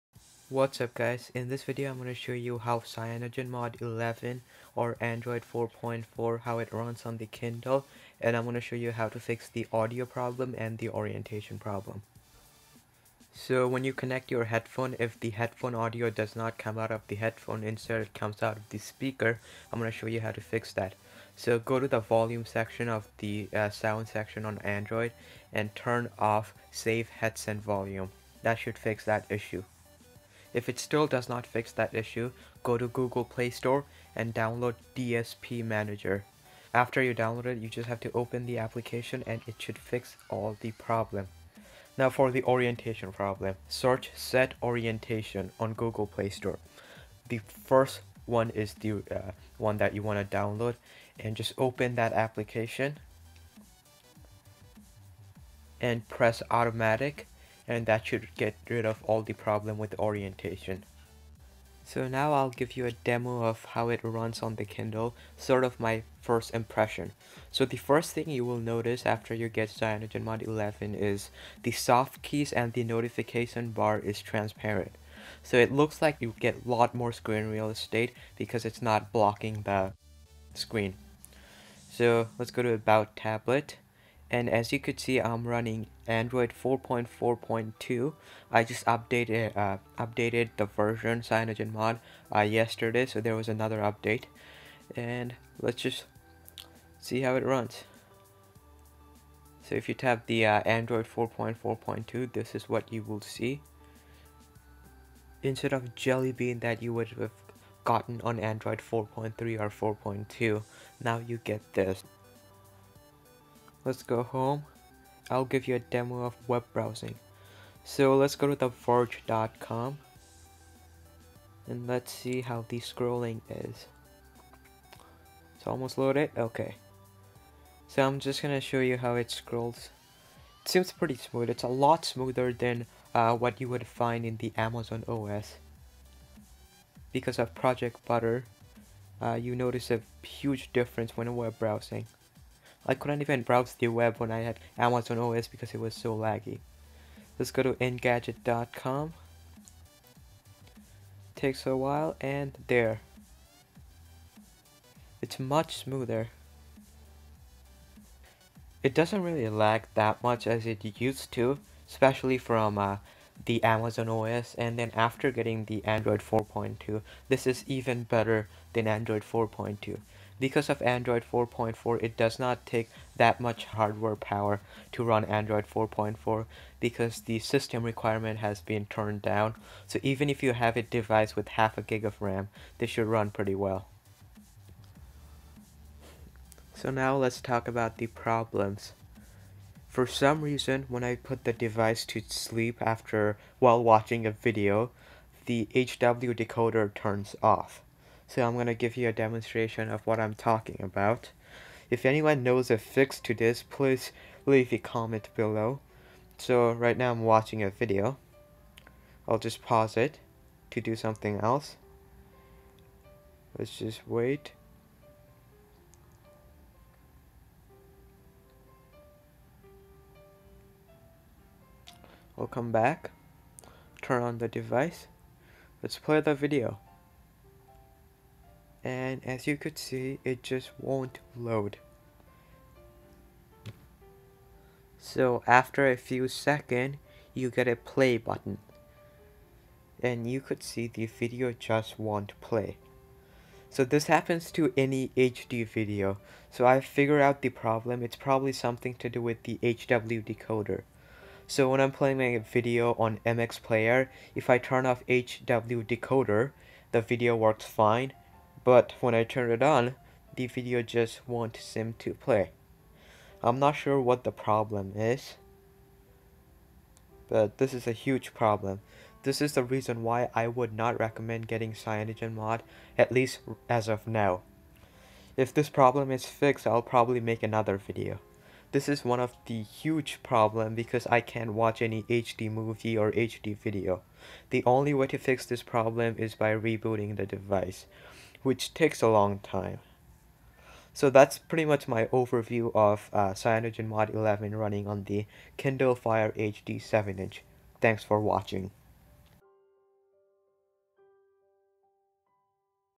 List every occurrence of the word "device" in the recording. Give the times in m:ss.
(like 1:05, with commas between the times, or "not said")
3:00, 3:11, 3:44, 4:47.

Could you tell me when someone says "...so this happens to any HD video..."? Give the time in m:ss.
4:03.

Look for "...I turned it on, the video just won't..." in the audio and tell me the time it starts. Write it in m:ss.
4:19.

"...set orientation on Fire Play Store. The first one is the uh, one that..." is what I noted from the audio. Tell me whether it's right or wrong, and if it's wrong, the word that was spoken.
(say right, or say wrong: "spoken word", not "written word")
wrong: "Google", not "Fire".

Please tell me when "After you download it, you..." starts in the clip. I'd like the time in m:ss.
0:36.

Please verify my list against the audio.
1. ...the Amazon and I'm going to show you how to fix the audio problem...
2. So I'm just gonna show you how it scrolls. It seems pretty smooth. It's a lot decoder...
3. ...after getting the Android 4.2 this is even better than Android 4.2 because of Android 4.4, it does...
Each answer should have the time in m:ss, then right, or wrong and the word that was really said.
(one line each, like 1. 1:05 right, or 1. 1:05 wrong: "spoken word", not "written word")
1. 0:07 wrong: "Kindle", not "Amazon"
2. 2:07 wrong: "smoother", not "decoder"
3. 2:44 right.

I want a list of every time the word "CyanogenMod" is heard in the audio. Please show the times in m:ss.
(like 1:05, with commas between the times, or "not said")
0:02, 1:09, 1:31, 4:31, 4:53.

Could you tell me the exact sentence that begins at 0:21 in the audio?
So go to the volume section of the uh, sound section on Android and turn off save headset volume.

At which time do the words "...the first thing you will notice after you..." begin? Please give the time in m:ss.
1:07.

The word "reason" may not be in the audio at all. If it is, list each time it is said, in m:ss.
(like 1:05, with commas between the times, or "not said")
3:10, 4:29.